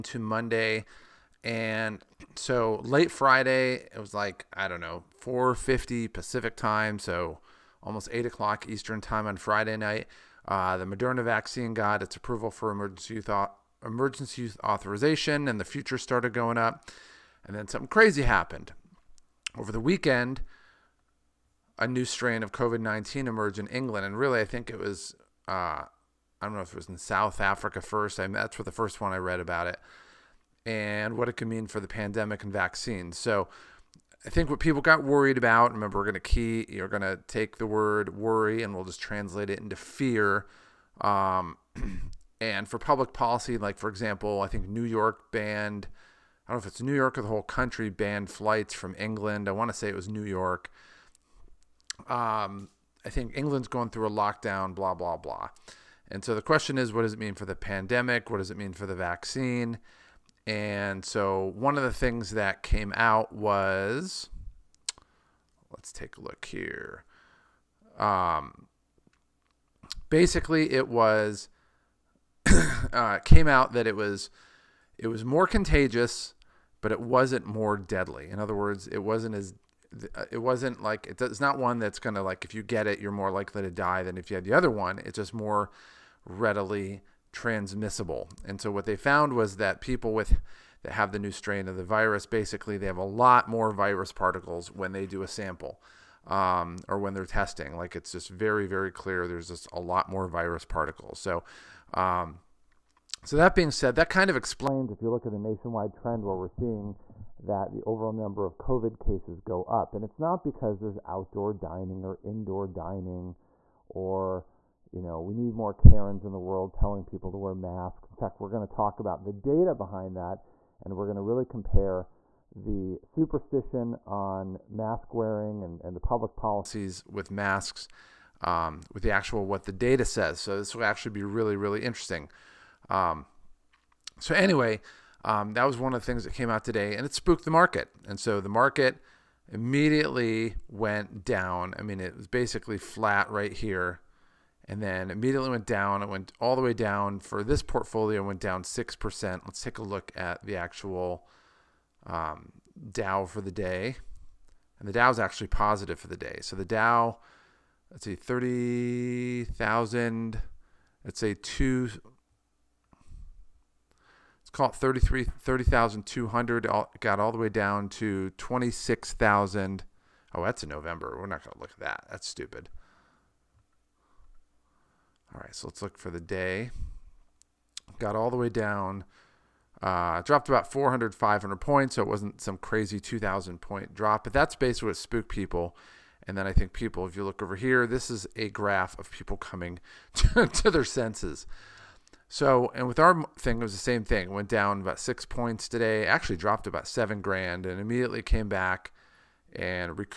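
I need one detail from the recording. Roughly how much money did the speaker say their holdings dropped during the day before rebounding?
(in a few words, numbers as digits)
About 7,000 dollars.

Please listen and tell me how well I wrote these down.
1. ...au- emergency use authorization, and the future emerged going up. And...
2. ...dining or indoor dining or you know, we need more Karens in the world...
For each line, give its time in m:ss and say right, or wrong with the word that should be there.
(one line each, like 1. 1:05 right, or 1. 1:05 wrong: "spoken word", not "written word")
1. 0:13 wrong: "started", not "emerged"
2. 1:51 right.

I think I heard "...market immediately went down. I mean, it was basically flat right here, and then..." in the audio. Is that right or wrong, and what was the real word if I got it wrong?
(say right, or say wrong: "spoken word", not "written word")
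right.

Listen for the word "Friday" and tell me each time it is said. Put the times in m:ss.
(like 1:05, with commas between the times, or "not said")
0:03, 0:09.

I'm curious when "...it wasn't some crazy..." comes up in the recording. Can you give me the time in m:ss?
3:02.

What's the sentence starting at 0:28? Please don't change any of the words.
I mean, that's what the first one I read about it, and what it could mean for the pandemic and vaccines.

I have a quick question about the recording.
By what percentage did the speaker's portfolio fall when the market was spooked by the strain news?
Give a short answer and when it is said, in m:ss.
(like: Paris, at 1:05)
6%, at 2:28.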